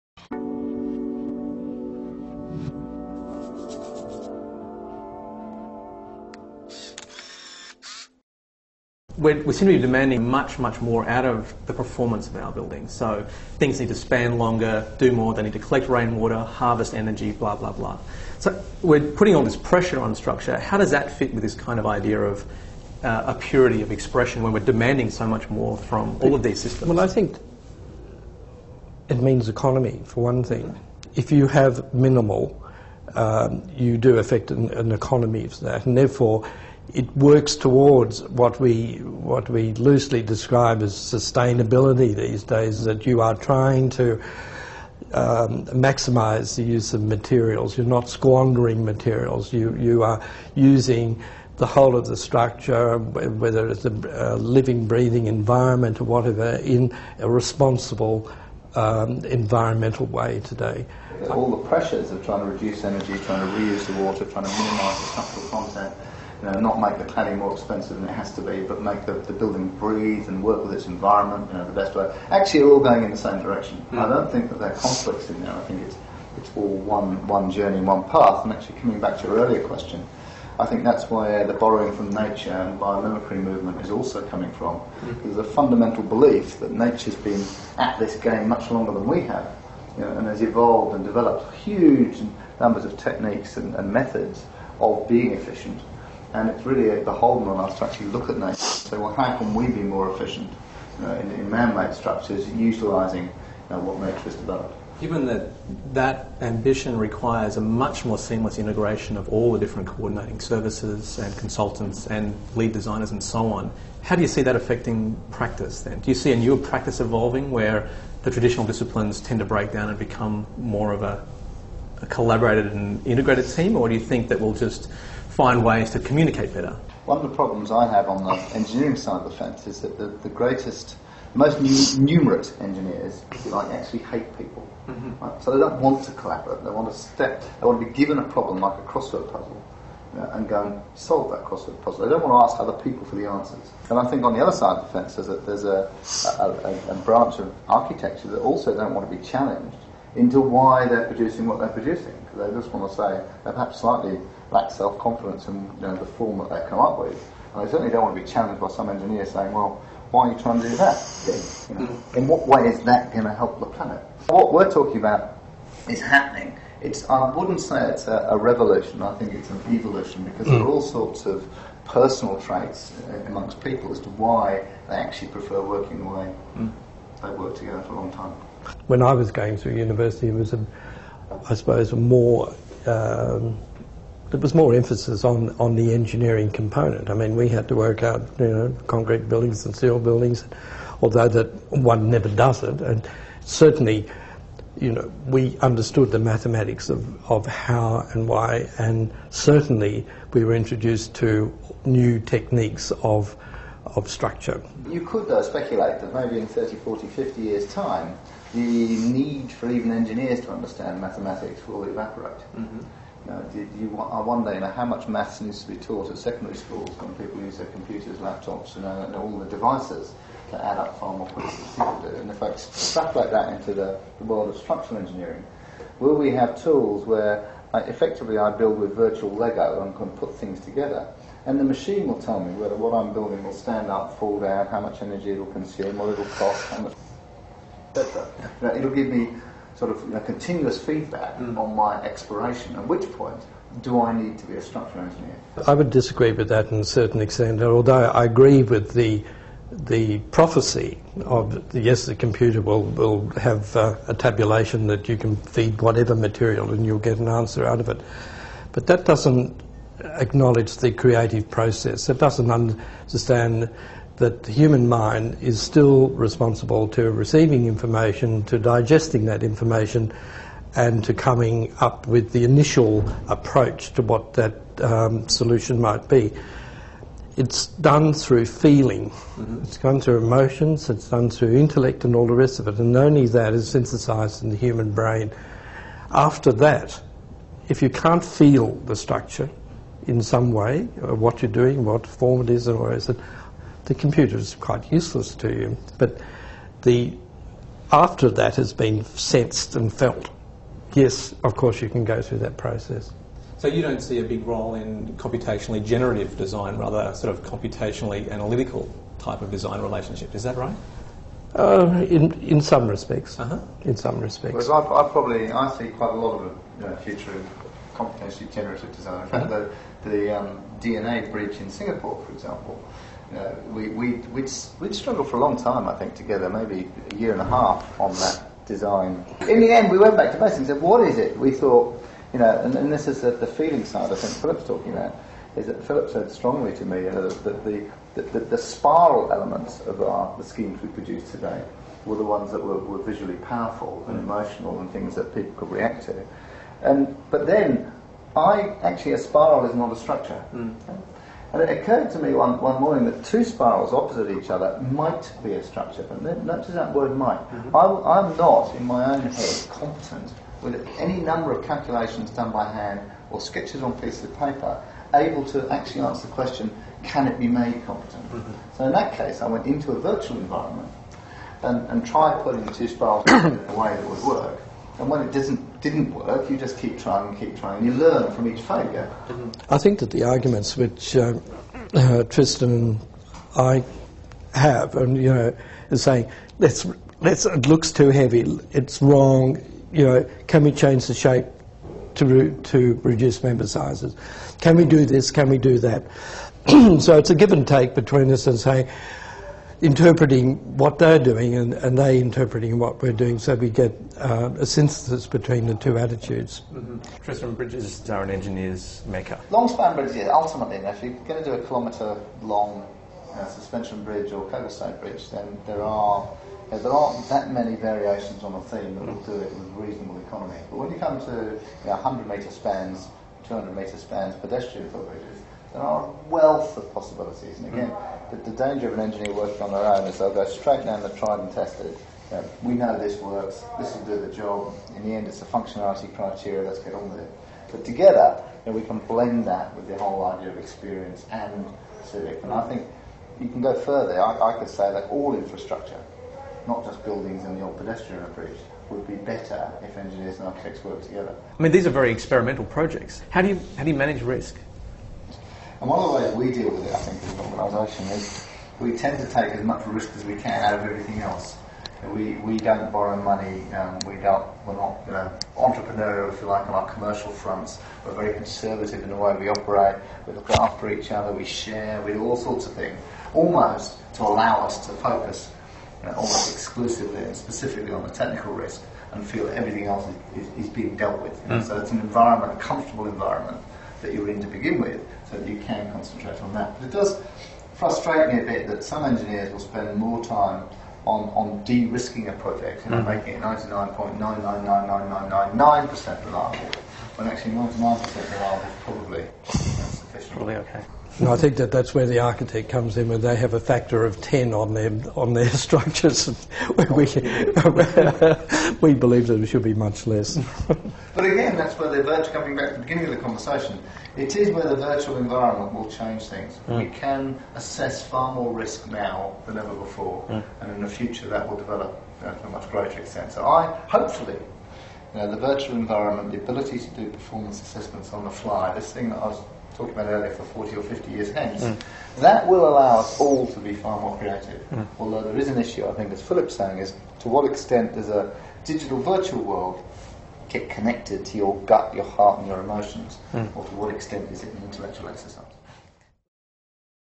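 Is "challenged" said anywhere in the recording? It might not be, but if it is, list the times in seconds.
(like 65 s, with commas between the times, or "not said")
149 s, 158 s.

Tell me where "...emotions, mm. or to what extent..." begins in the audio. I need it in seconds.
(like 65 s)
542 s.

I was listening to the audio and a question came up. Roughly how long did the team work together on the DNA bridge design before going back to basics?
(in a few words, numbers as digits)
a year and a half.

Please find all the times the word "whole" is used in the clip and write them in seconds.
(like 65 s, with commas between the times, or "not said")
51 s, 439 s.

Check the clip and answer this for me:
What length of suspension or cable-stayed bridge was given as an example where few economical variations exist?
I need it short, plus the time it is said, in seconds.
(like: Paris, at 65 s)
1 kilometre, at 411 s.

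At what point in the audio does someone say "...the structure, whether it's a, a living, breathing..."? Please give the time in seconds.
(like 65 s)
52 s.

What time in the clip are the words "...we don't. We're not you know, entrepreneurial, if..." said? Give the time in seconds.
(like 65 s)
464 s.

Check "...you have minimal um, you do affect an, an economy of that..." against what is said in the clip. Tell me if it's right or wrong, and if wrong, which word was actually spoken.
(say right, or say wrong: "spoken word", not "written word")
right.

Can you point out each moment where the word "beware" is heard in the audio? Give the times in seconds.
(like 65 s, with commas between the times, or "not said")
not said.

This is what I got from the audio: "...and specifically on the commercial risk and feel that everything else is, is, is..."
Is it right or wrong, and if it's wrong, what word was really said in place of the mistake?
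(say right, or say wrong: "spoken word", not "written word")
wrong: "technical", not "commercial".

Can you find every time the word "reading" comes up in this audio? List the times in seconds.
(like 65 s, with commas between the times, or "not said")
not said.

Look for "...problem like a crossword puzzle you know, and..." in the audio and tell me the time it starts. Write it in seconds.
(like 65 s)
138 s.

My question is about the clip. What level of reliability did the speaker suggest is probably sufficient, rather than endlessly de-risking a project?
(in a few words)
99%.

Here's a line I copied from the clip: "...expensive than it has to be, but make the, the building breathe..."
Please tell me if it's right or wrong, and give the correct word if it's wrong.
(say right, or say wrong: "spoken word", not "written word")
right.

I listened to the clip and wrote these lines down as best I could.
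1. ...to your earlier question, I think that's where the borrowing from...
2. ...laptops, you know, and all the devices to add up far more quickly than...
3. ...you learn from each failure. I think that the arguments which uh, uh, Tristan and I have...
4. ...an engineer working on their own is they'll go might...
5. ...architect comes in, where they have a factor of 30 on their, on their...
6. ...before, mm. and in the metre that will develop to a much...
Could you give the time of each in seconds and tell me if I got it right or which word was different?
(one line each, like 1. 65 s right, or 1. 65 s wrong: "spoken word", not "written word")
1. 79 s right
2. 218 s right
3. 377 s right
4. 428 s wrong: "straight", not "might"
5. 502 s wrong: "10", not "30"
6. 519 s wrong: "future", not "metre".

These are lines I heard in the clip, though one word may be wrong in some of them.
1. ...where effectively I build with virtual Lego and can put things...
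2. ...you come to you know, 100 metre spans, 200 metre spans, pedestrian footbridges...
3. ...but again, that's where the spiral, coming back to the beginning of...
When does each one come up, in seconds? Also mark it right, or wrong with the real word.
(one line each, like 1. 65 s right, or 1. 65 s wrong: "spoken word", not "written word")
1. 227 s right
2. 420 s right
3. 510 s wrong: "virtual", not "spiral".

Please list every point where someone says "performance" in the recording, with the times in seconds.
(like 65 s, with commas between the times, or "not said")
11 s, 527 s.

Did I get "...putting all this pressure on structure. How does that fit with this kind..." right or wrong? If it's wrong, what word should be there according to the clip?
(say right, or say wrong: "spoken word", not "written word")
right.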